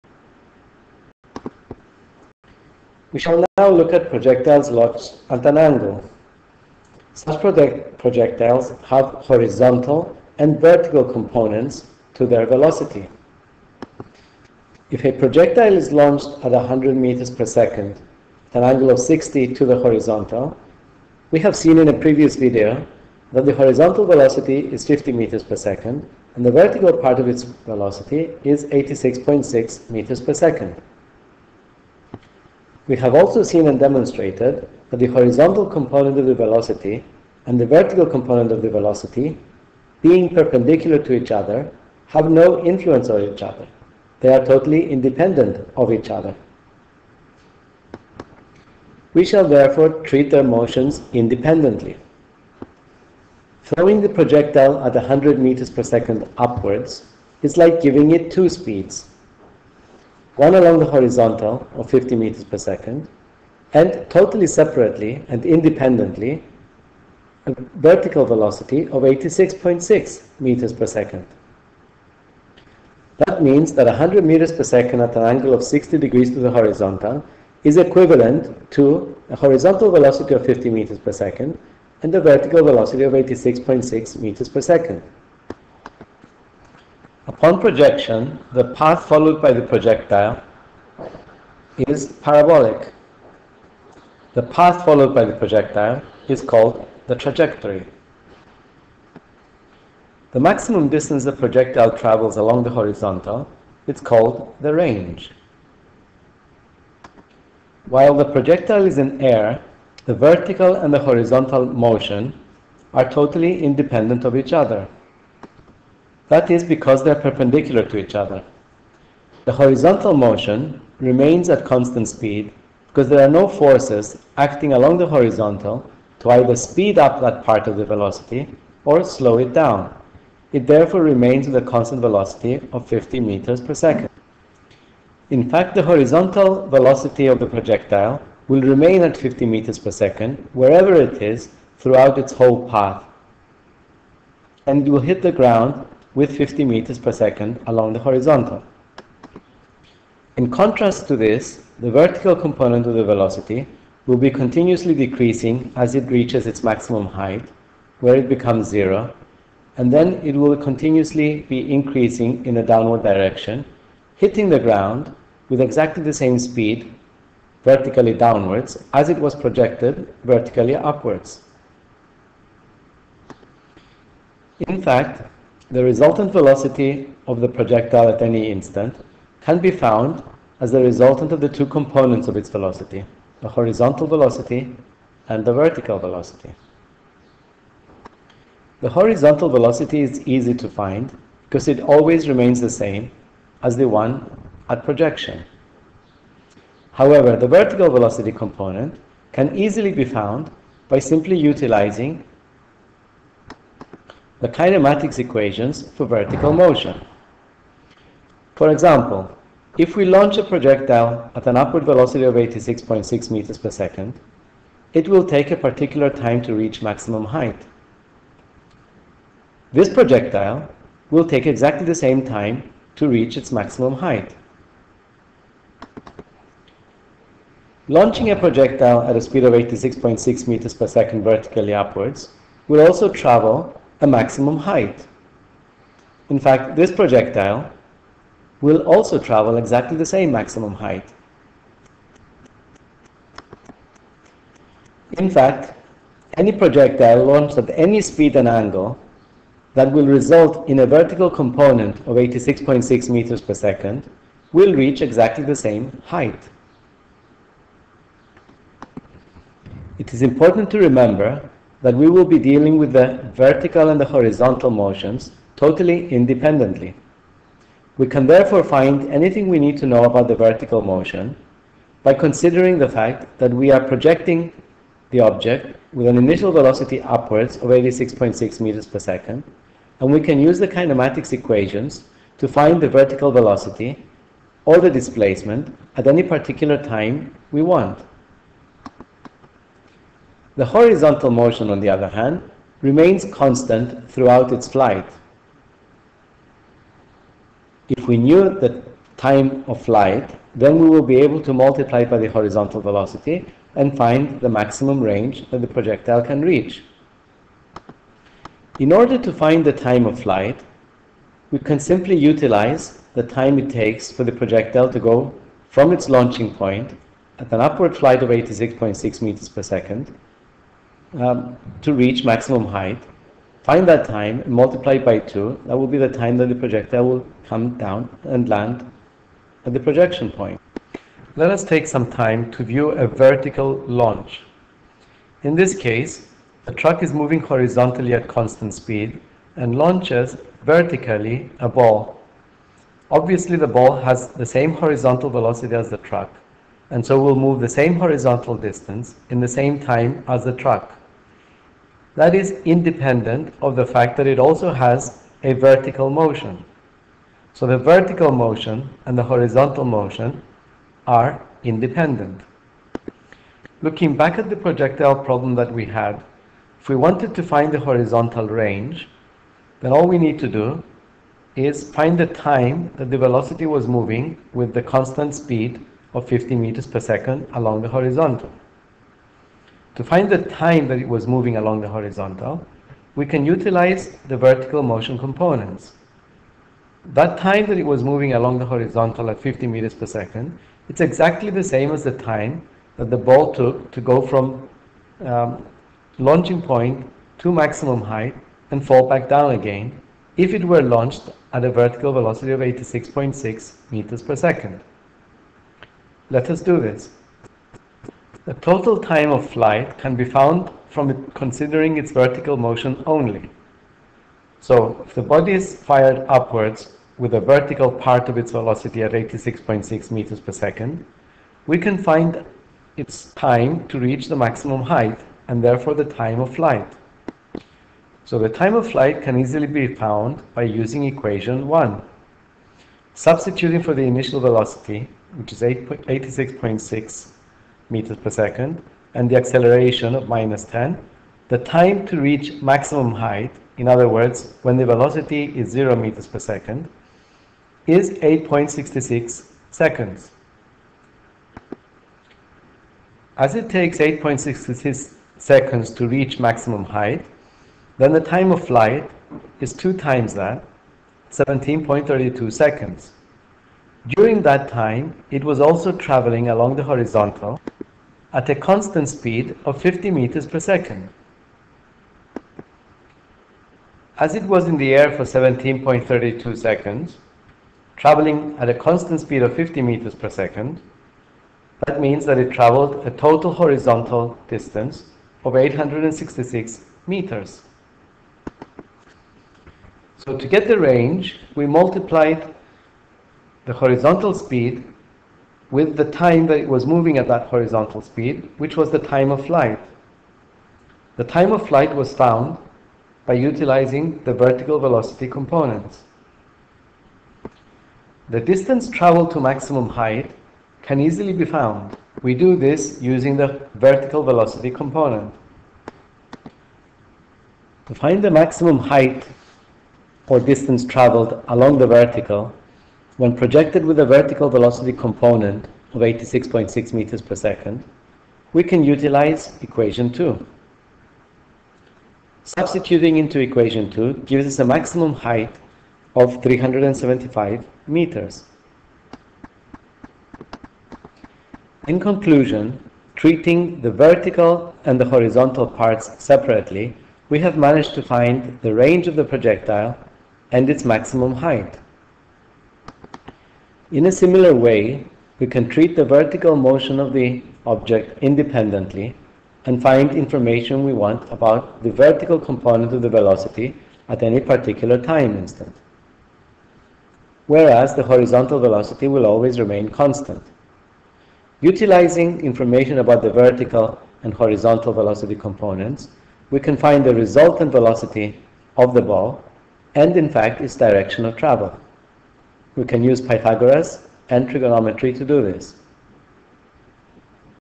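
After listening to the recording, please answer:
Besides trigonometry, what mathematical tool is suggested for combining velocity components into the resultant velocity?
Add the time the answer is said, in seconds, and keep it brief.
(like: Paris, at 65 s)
Pythagoras, at 583 s.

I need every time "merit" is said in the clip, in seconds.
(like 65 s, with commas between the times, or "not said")
not said.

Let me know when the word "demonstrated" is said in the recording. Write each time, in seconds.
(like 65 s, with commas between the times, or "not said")
33 s.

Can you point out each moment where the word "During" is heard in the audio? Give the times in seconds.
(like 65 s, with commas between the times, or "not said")
464 s.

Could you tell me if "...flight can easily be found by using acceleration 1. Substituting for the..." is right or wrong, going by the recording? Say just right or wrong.
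wrong.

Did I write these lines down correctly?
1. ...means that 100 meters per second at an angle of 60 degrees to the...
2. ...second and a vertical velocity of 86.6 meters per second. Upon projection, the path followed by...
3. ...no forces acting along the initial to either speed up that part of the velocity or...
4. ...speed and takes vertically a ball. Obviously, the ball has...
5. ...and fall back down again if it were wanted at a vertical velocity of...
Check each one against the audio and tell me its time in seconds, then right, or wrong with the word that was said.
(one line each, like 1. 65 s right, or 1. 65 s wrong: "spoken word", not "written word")
1. 73 s right
2. 81 s right
3. 123 s wrong: "horizontal", not "initial"
4. 338 s wrong: "launches", not "takes"
5. 398 s wrong: "launched", not "wanted".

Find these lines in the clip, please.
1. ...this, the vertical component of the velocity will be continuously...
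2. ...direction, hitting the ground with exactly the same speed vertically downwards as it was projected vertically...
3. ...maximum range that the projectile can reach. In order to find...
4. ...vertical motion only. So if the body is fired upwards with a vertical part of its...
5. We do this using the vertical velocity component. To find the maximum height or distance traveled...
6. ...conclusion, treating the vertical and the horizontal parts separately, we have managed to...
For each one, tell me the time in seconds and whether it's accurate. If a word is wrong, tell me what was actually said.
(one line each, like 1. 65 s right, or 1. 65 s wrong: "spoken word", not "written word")
1. 151 s right
2. 163 s right
3. 304 s right
4. 412 s right
5. 512 s right
6. 541 s right.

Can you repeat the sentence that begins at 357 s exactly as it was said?
So the vertical motion and the horizontal motion are independent.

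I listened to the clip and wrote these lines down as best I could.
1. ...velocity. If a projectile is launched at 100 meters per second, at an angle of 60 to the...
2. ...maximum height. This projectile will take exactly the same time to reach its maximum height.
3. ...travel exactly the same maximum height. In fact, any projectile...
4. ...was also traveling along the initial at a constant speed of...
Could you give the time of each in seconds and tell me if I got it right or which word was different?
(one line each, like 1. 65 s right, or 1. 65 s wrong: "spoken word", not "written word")
1. 12 s right
2. 216 s right
3. 239 s right
4. 465 s wrong: "horizontal", not "initial".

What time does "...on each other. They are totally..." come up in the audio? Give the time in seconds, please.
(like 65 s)
43 s.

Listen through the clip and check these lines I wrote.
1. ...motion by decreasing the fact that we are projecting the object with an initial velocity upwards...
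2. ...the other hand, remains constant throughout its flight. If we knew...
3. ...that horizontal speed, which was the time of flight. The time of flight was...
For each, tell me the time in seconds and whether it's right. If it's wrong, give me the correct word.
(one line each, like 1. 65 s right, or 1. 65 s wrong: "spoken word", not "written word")
1. 270 s wrong: "considering", not "decreasing"
2. 291 s right
3. 497 s right.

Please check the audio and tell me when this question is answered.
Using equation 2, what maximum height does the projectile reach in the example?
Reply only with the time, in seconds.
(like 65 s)
536 s.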